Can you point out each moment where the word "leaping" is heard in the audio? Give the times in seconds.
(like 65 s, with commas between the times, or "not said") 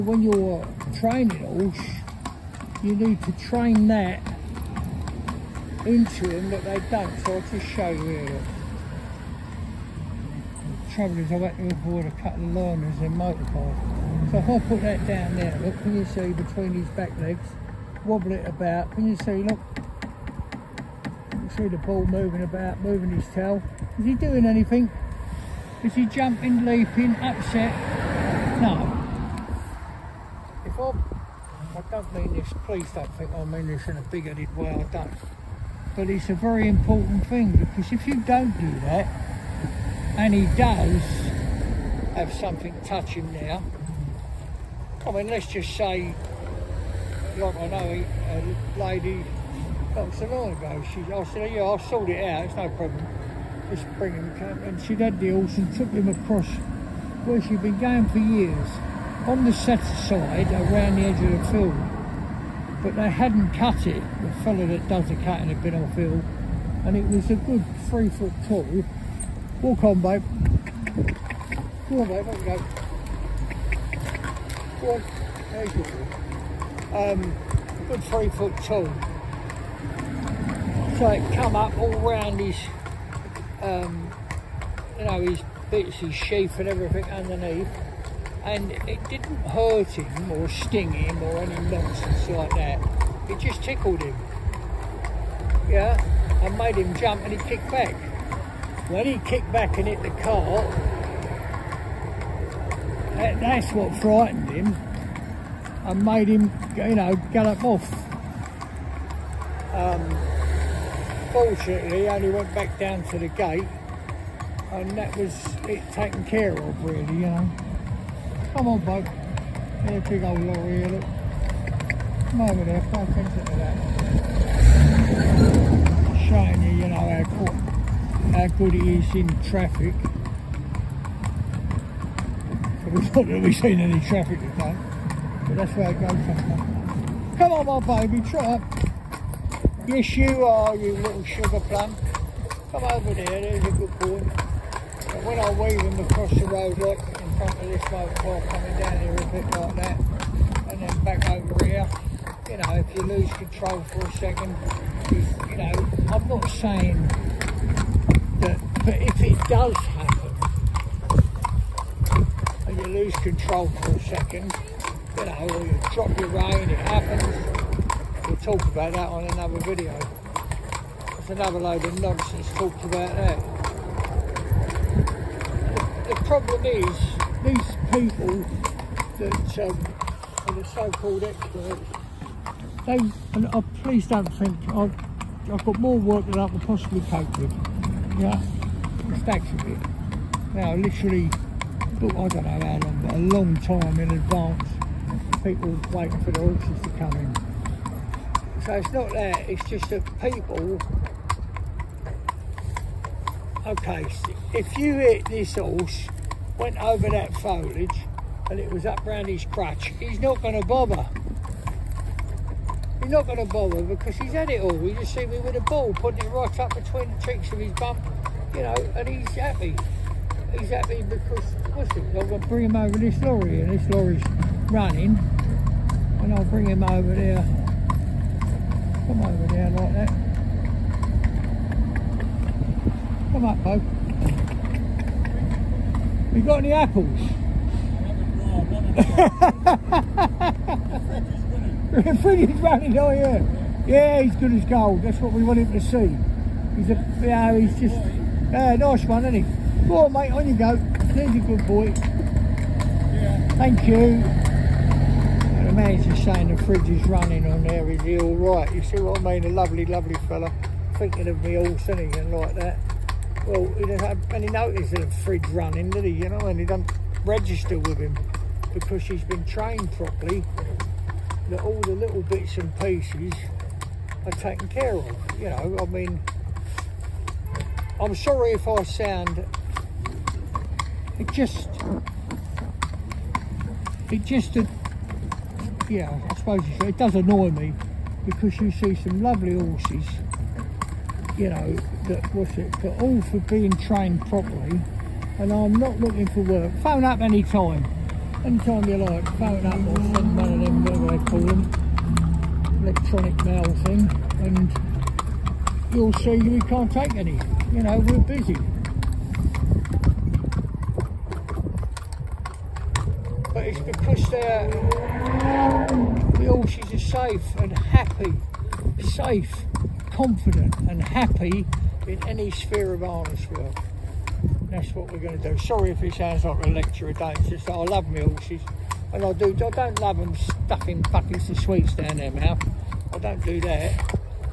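26 s.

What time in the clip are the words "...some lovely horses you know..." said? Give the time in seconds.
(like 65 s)
288 s.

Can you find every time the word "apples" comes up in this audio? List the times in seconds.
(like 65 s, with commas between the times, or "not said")
236 s.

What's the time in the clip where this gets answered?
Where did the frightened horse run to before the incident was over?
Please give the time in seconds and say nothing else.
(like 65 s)
112 s.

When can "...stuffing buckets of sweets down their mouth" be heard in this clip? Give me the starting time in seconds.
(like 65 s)
330 s.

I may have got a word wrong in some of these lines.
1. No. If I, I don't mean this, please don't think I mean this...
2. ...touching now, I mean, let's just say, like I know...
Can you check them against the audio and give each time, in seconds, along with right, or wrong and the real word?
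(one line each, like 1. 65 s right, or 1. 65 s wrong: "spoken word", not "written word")
1. 28 s right
2. 42 s right.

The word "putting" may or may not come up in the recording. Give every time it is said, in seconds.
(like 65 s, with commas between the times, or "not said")
215 s.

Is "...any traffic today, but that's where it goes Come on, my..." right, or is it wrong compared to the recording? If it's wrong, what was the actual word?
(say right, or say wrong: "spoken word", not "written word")
right.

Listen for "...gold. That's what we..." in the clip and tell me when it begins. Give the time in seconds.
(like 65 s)
244 s.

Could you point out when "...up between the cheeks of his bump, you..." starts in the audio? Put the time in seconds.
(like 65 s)
216 s.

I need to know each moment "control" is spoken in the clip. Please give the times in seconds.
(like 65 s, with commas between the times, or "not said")
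153 s, 163 s.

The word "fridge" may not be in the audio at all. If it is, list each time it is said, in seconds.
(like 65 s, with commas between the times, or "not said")
242 s, 256 s, 265 s.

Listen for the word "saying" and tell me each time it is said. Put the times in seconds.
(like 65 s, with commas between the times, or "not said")
156 s, 256 s.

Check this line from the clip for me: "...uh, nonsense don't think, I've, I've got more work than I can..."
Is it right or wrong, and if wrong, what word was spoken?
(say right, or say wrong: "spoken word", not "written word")
wrong: "please", not "nonsense".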